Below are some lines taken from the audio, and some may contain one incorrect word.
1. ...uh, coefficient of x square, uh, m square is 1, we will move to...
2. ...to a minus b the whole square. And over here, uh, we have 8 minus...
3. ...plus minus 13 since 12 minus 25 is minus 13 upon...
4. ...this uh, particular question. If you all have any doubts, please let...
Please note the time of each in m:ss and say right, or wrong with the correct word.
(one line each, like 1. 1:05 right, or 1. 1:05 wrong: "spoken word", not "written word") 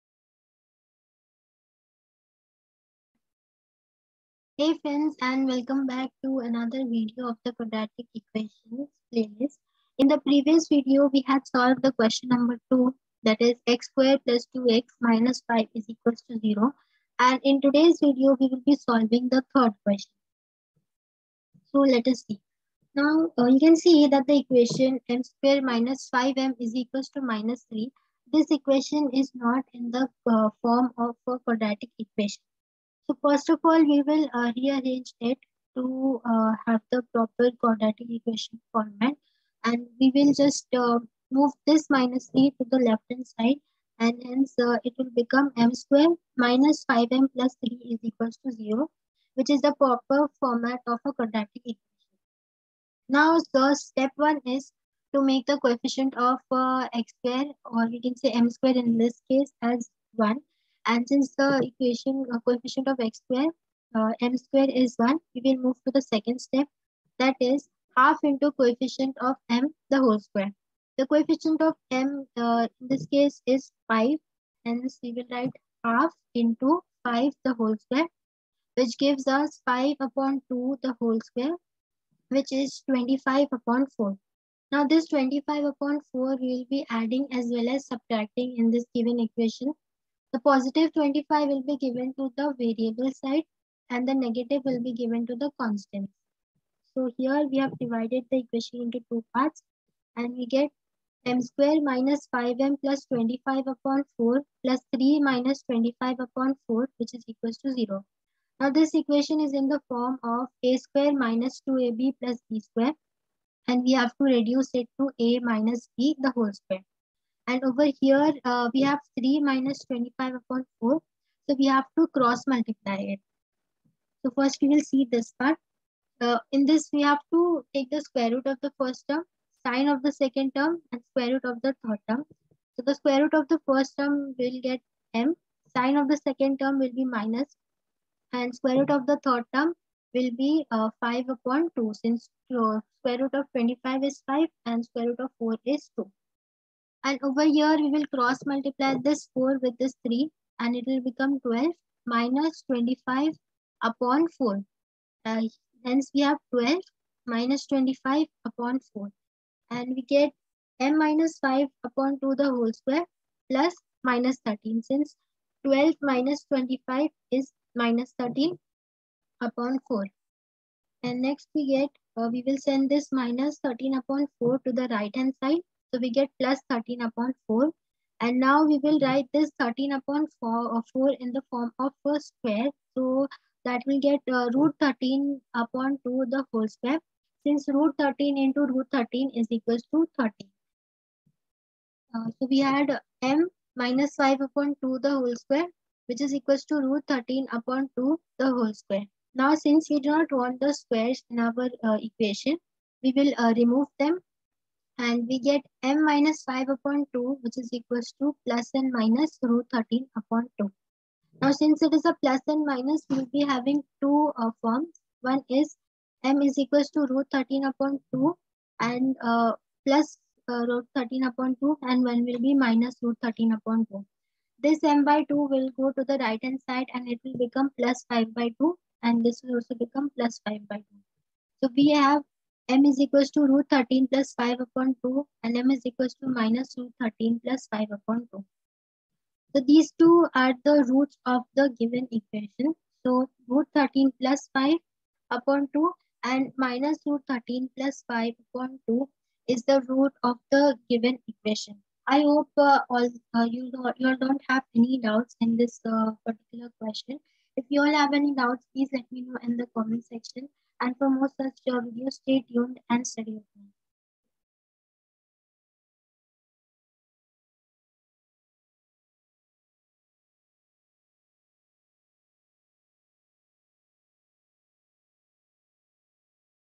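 1. 1:02 right
2. 1:54 wrong: "3", not "8"
3. 2:43 right
4. 4:15 right.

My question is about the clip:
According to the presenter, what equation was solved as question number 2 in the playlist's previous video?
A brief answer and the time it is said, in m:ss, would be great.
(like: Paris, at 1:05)
x^2 + 2x - 5 = 0, at 0:13.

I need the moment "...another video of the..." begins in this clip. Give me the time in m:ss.
0:06.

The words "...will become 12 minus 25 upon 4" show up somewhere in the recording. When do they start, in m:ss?
2:30.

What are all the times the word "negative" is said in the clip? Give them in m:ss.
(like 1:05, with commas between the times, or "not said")
1:34.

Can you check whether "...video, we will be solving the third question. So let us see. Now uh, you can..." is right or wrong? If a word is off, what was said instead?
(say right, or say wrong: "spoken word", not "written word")
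right.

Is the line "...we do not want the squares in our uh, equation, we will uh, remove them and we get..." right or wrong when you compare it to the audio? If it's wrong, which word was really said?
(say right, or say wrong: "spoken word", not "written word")
right.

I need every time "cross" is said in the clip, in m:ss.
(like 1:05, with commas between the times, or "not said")
2:02, 2:28.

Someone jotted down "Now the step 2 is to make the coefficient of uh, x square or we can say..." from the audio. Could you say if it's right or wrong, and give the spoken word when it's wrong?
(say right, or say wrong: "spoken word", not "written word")
wrong: "1", not "2".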